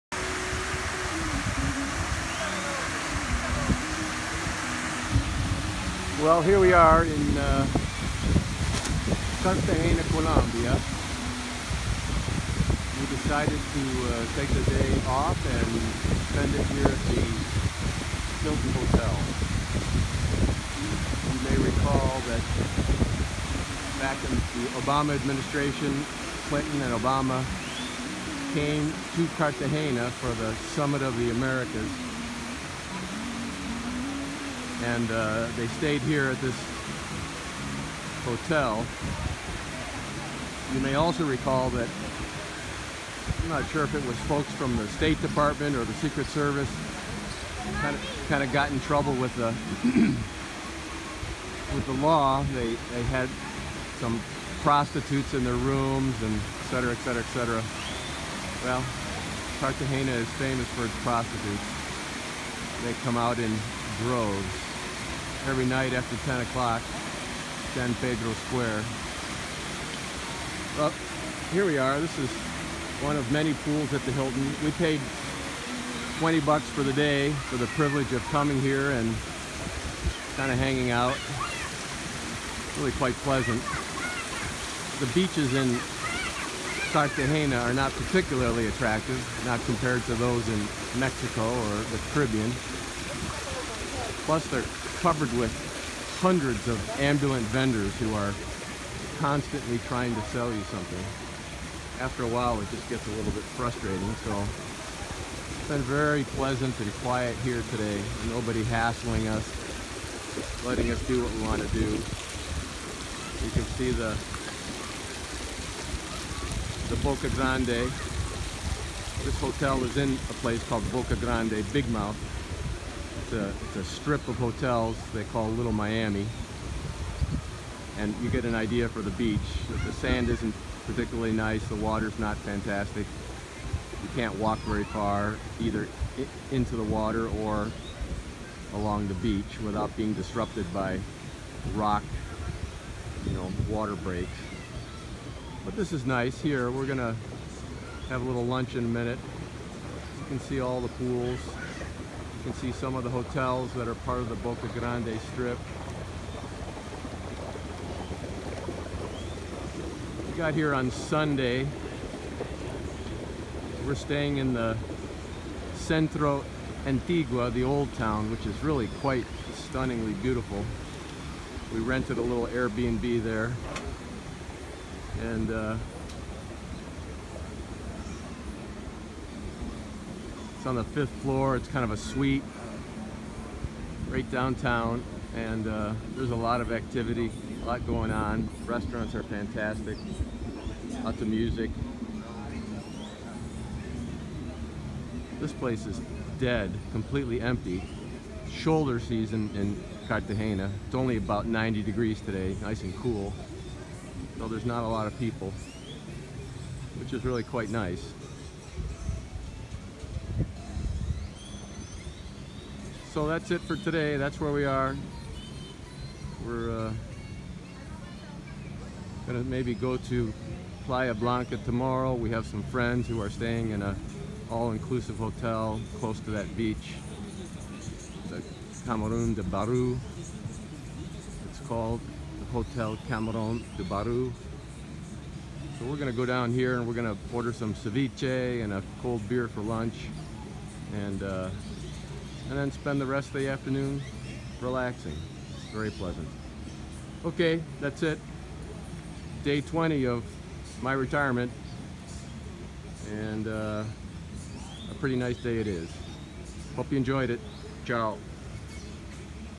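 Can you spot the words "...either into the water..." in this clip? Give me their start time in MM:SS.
02:15.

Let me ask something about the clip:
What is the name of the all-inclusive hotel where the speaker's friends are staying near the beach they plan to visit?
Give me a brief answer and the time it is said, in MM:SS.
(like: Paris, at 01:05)
Hotel Camarón de Barú, at 03:52.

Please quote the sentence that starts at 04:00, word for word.
And uh, and then spend the rest of the afternoon relaxing.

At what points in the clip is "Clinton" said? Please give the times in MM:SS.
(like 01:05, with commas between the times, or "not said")
00:26.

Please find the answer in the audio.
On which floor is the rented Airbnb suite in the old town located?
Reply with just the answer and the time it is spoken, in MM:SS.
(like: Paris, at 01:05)
Fifth floor, at 03:00.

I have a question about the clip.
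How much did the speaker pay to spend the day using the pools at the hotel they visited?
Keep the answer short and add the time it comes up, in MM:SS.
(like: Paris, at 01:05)
$20, at 01:16.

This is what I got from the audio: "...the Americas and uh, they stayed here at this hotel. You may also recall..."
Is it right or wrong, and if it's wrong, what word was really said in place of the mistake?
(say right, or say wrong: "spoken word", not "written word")
right.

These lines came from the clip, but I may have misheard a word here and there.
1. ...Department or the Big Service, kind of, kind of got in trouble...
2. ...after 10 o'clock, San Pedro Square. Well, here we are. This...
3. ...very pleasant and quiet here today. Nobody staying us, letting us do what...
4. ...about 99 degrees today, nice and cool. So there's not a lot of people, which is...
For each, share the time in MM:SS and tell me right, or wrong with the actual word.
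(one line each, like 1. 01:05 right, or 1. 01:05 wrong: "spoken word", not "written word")
1. 00:45 wrong: "Secret", not "Big"
2. 01:05 right
3. 01:45 wrong: "hassling", not "staying"
4. 03:21 wrong: "90", not "99".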